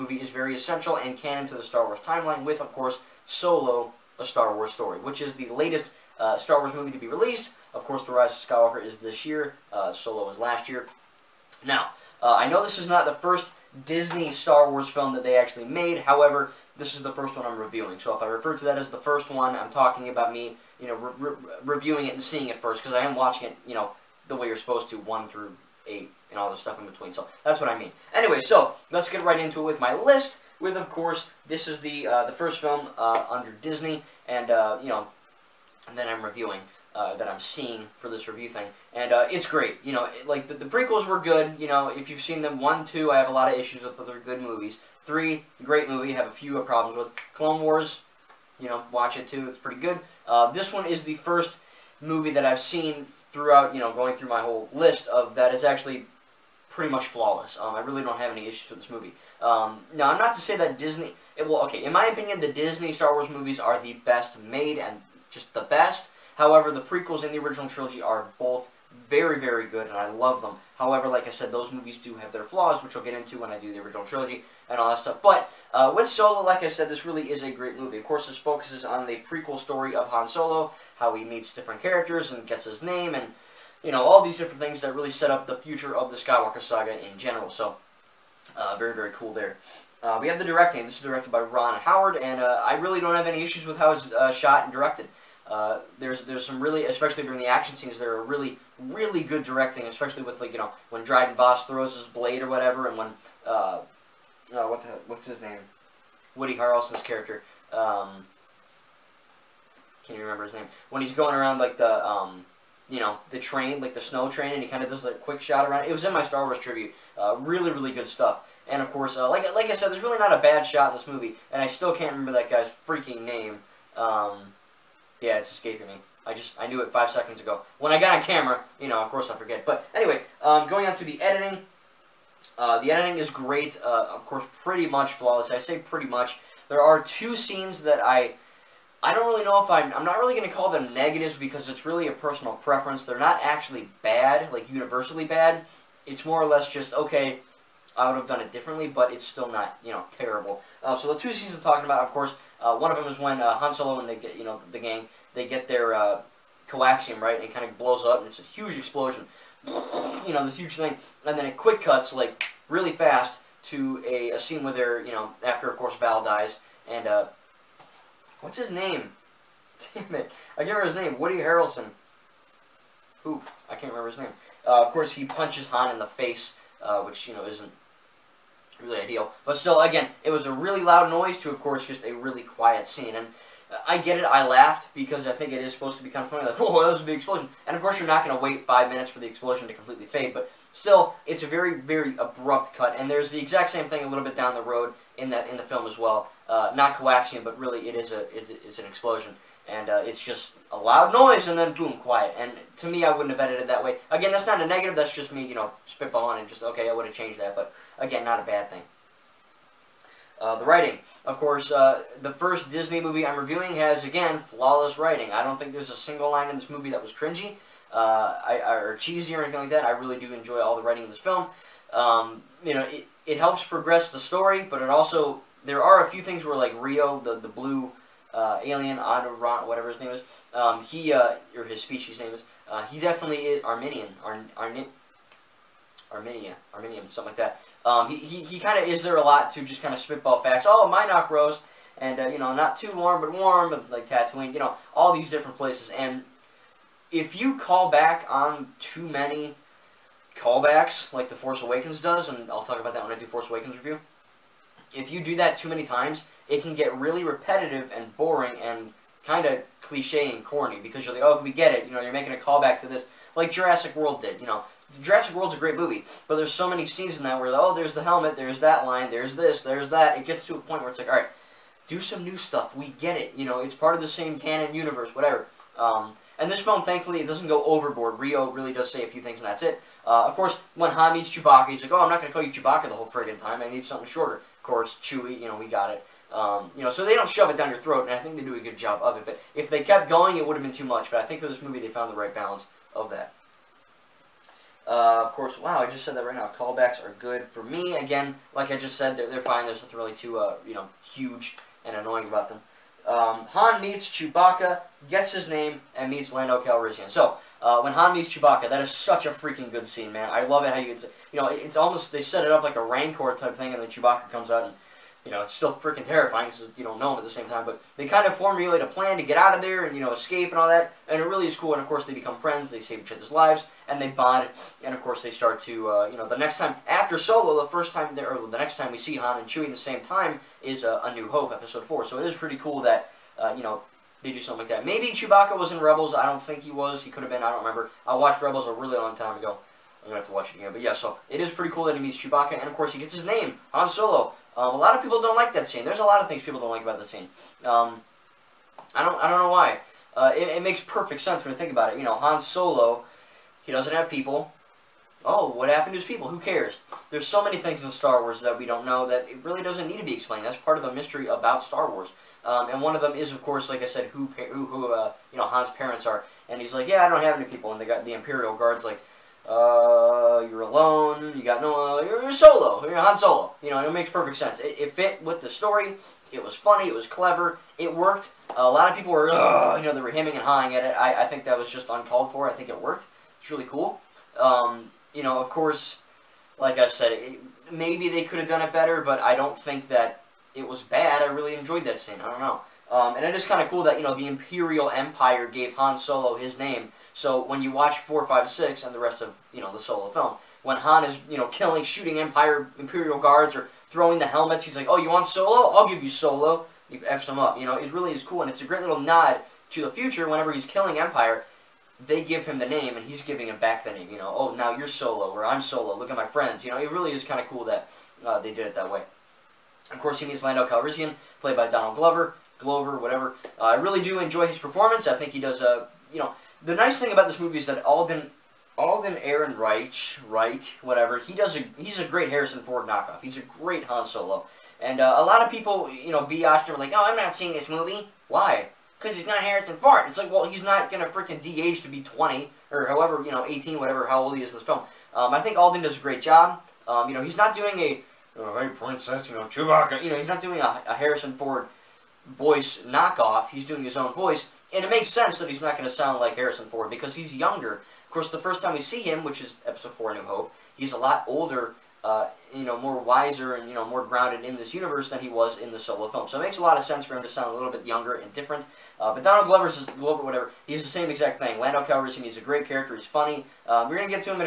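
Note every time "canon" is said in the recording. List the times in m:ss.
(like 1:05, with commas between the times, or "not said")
0:01, 4:34.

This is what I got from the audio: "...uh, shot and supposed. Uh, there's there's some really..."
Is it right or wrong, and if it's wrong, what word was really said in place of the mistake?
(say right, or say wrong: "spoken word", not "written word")
wrong: "directed", not "supposed".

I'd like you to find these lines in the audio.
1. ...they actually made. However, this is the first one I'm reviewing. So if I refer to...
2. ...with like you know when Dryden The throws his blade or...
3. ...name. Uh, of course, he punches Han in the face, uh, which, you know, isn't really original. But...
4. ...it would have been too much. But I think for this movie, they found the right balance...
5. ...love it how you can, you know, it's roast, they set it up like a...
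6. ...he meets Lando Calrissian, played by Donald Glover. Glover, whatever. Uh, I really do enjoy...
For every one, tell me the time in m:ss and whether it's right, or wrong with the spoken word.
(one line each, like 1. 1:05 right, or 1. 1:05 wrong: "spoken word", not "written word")
1. 0:15 right
2. 1:40 wrong: "Voss", not "The"
3. 2:54 wrong: "ideal", not "original"
4. 4:50 right
5. 5:10 wrong: "almost", not "roast"
6. 7:00 right.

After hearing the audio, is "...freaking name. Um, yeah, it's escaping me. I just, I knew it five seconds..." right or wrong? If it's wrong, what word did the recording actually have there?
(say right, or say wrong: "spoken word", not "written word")
right.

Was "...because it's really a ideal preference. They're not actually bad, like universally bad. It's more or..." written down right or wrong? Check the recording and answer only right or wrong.
wrong.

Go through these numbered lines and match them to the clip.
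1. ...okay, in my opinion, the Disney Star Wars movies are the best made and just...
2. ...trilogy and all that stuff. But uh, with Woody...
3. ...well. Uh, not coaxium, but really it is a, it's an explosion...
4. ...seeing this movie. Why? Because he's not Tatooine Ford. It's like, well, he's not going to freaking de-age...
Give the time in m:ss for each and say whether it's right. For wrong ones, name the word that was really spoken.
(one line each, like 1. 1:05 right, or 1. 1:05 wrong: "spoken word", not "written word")
1. 1:01 right
2. 1:14 wrong: "Solo", not "Woody"
3. 3:15 right
4. 7:17 wrong: "Harrison", not "Tatooine".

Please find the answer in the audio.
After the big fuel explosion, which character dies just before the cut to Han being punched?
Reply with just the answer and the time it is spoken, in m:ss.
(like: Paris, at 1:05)
Val, at 2:45.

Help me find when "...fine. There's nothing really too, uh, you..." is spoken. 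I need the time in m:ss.
4:59.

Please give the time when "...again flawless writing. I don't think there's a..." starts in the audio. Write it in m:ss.
3:34.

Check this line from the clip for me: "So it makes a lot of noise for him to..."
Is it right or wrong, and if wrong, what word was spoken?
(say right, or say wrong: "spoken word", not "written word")
wrong: "sense", not "noise".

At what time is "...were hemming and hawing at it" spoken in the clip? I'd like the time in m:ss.
6:20.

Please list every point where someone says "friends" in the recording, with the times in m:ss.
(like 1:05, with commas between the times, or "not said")
5:22, 6:56.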